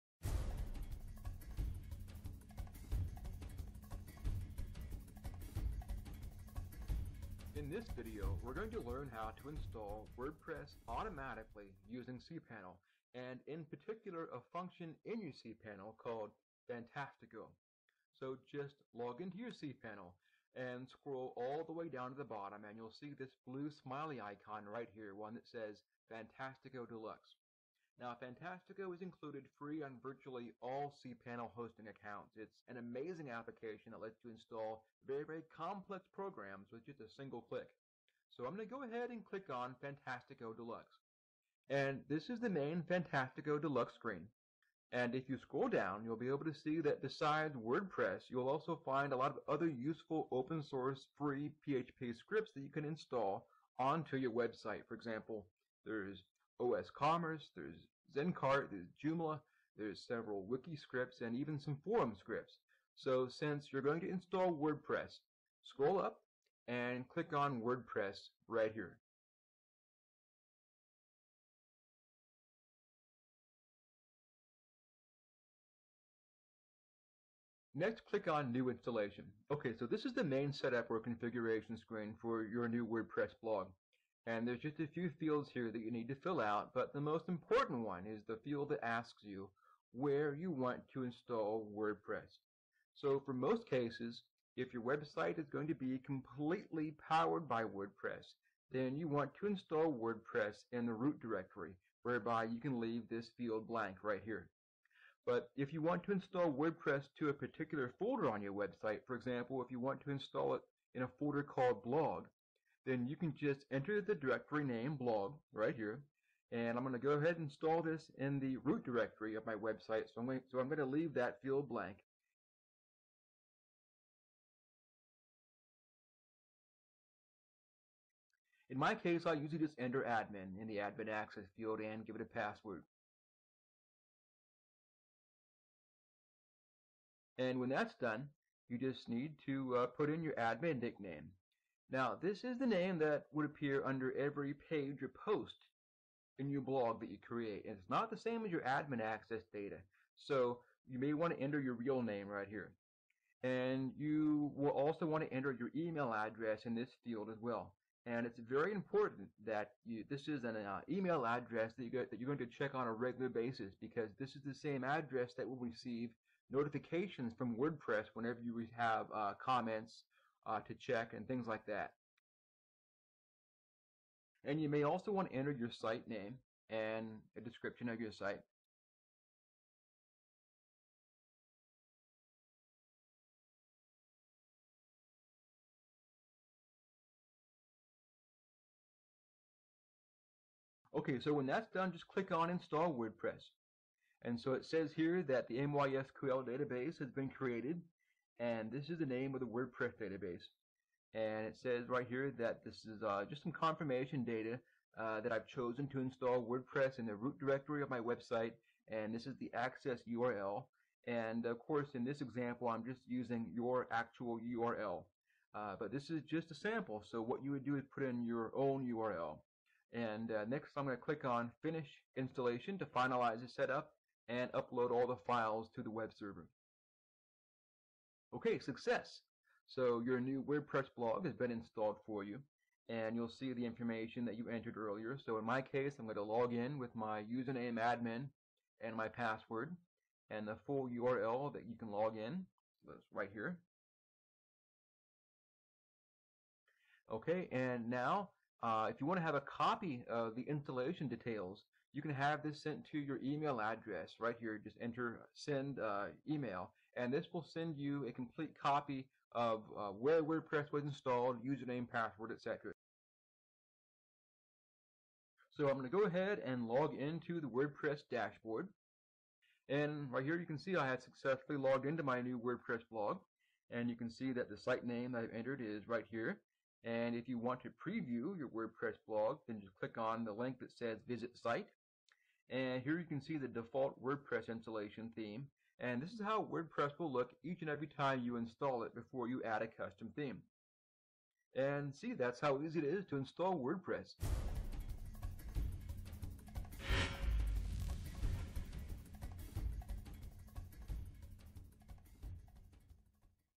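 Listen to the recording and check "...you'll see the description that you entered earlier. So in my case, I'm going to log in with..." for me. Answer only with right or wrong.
wrong.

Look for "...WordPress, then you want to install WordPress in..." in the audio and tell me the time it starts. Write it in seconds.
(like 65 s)
97 s.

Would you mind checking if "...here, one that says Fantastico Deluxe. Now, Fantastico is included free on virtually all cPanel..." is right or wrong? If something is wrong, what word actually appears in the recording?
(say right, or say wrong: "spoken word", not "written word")
right.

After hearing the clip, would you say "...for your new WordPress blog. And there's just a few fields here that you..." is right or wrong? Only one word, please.
right.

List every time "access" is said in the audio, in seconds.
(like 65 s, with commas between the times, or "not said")
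131 s, 149 s, 209 s.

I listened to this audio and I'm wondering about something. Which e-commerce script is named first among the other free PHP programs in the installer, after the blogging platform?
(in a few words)
OS Commerce.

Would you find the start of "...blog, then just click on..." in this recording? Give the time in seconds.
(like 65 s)
279 s.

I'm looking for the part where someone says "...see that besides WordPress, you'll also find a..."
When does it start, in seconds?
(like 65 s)
46 s.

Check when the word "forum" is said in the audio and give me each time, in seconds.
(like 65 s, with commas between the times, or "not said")
61 s.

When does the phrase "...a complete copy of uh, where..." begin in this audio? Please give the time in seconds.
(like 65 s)
258 s.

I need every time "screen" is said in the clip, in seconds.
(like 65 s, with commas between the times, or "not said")
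43 s, 81 s.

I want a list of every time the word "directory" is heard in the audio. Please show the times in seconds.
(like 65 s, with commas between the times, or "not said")
101 s, 114 s, 118 s, 207 s.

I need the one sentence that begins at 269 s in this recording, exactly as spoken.
And right here you can see I had successfully logged into my new WordPress blog.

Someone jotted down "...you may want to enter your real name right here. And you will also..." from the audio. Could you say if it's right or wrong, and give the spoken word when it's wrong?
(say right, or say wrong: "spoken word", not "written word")
right.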